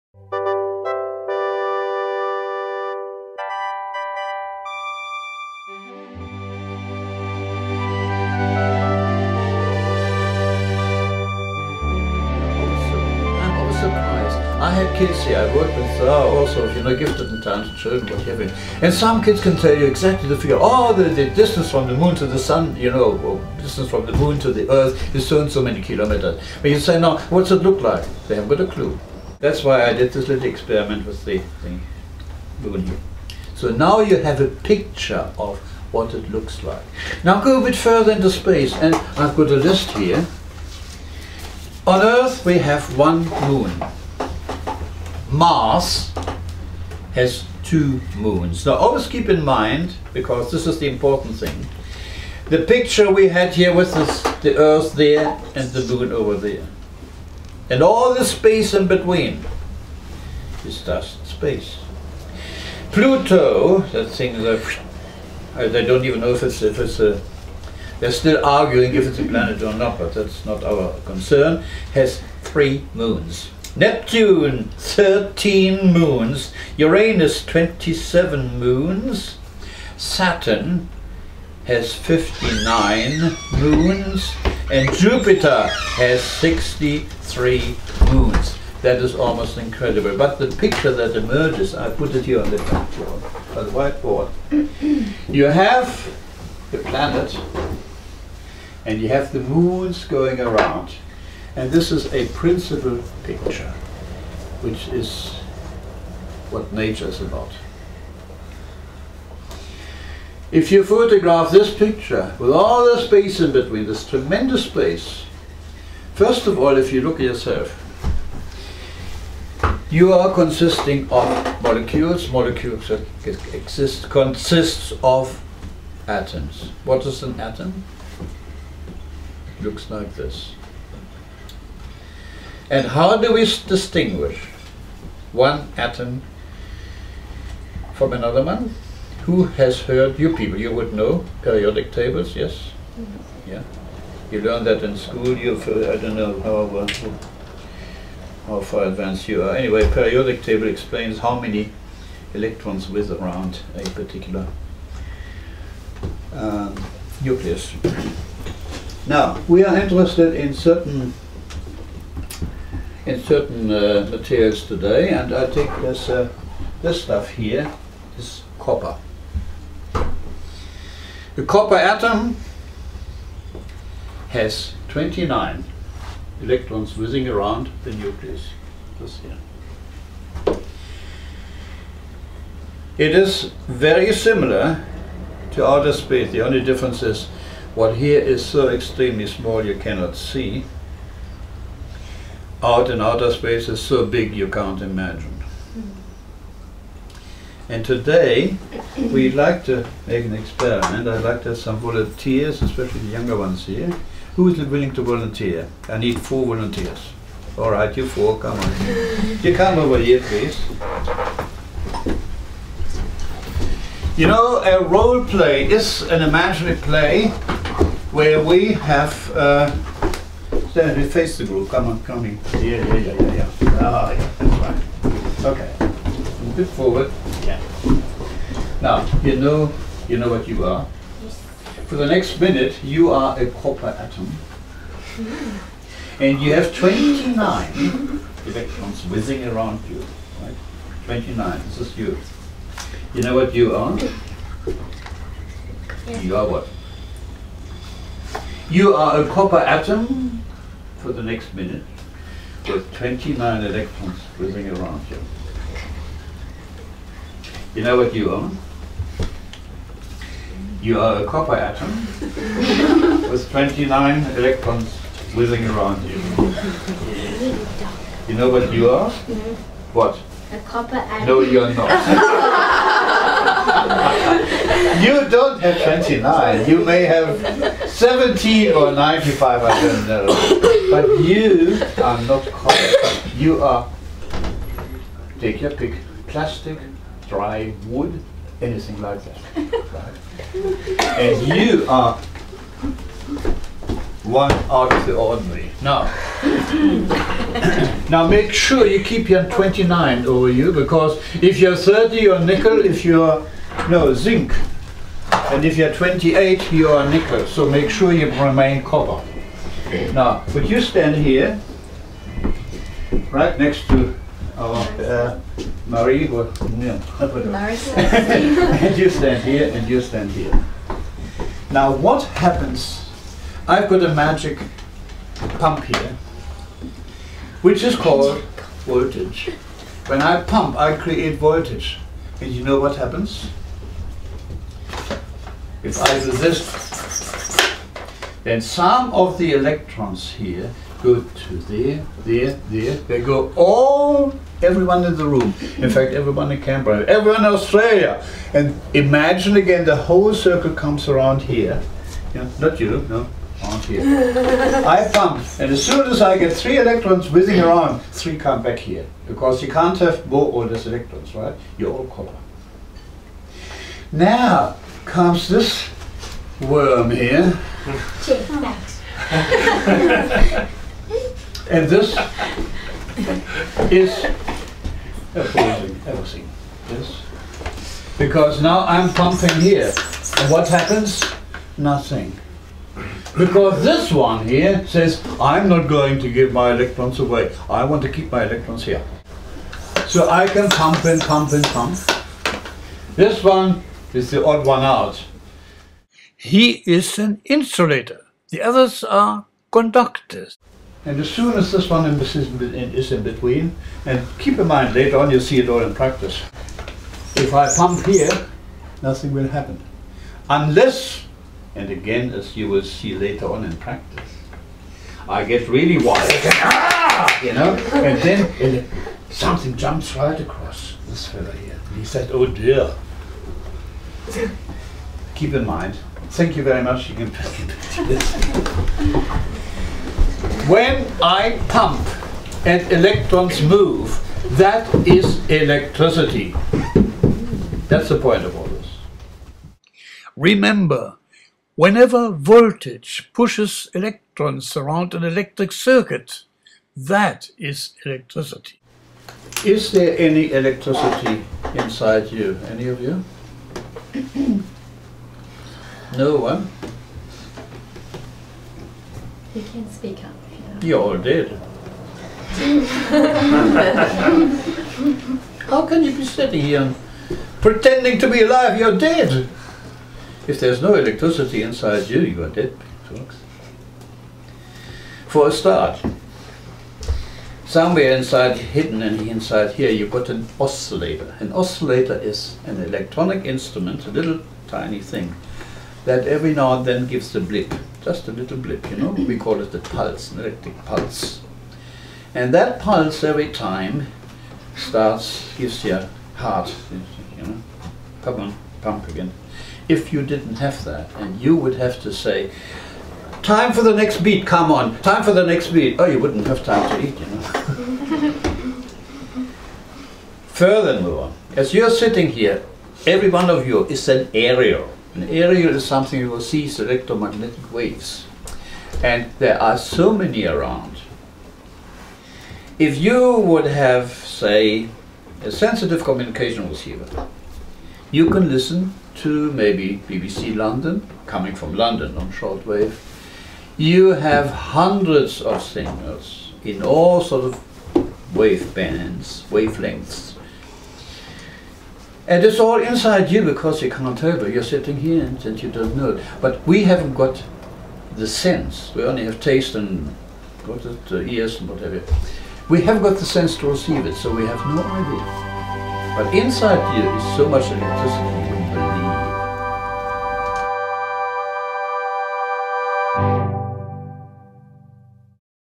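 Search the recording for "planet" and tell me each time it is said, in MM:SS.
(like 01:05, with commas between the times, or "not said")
01:09, 01:36.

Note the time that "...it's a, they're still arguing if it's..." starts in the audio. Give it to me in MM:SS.
01:06.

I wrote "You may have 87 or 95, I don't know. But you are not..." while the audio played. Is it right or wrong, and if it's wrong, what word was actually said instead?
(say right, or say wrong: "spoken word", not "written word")
wrong: "17", not "87".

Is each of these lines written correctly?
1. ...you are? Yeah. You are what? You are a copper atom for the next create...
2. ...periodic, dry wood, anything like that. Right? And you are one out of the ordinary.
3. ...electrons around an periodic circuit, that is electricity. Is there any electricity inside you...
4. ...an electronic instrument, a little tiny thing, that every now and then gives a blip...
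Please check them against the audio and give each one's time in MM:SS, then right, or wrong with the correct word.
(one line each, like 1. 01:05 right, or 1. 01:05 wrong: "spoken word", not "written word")
1. 04:03 wrong: "minute", not "create"
2. 04:46 wrong: "plastic", not "periodic"
3. 07:23 wrong: "electric", not "periodic"
4. 08:02 right.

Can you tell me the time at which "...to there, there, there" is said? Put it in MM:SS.
05:41.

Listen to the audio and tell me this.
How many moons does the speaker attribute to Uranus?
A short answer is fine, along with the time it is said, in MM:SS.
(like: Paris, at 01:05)
27, at 01:17.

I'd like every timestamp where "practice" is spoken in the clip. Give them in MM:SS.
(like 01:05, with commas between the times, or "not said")
06:45, 06:53.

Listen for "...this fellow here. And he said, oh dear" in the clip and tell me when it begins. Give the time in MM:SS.
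07:01.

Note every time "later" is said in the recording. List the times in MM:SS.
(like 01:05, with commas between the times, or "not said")
06:44, 06:53.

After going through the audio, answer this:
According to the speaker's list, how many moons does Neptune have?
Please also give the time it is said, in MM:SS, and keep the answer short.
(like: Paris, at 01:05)
13, at 01:14.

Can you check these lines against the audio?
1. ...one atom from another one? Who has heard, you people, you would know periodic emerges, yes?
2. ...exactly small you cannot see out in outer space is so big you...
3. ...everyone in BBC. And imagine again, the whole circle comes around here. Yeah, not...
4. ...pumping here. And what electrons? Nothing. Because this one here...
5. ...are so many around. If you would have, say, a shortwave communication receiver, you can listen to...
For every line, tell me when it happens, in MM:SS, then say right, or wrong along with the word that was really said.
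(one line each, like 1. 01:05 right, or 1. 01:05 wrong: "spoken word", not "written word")
1. 02:15 wrong: "tables", not "emerges"
2. 03:08 wrong: "extremely", not "exactly"
3. 05:47 wrong: "Australia", not "BBC"
4. 06:19 wrong: "happens", not "electrons"
5. 08:39 wrong: "sensitive", not "shortwave".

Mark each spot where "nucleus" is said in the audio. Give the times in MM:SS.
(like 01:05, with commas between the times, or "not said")
02:37, 02:57.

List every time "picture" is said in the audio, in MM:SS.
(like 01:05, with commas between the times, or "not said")
00:34, 00:52, 01:30, 01:43, 01:51.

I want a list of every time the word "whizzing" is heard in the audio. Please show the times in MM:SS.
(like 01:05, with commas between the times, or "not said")
02:56, 03:59, 04:14, 04:25, 05:57.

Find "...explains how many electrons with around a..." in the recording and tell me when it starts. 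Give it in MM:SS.
02:30.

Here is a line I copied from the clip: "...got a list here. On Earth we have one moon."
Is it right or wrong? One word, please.
right.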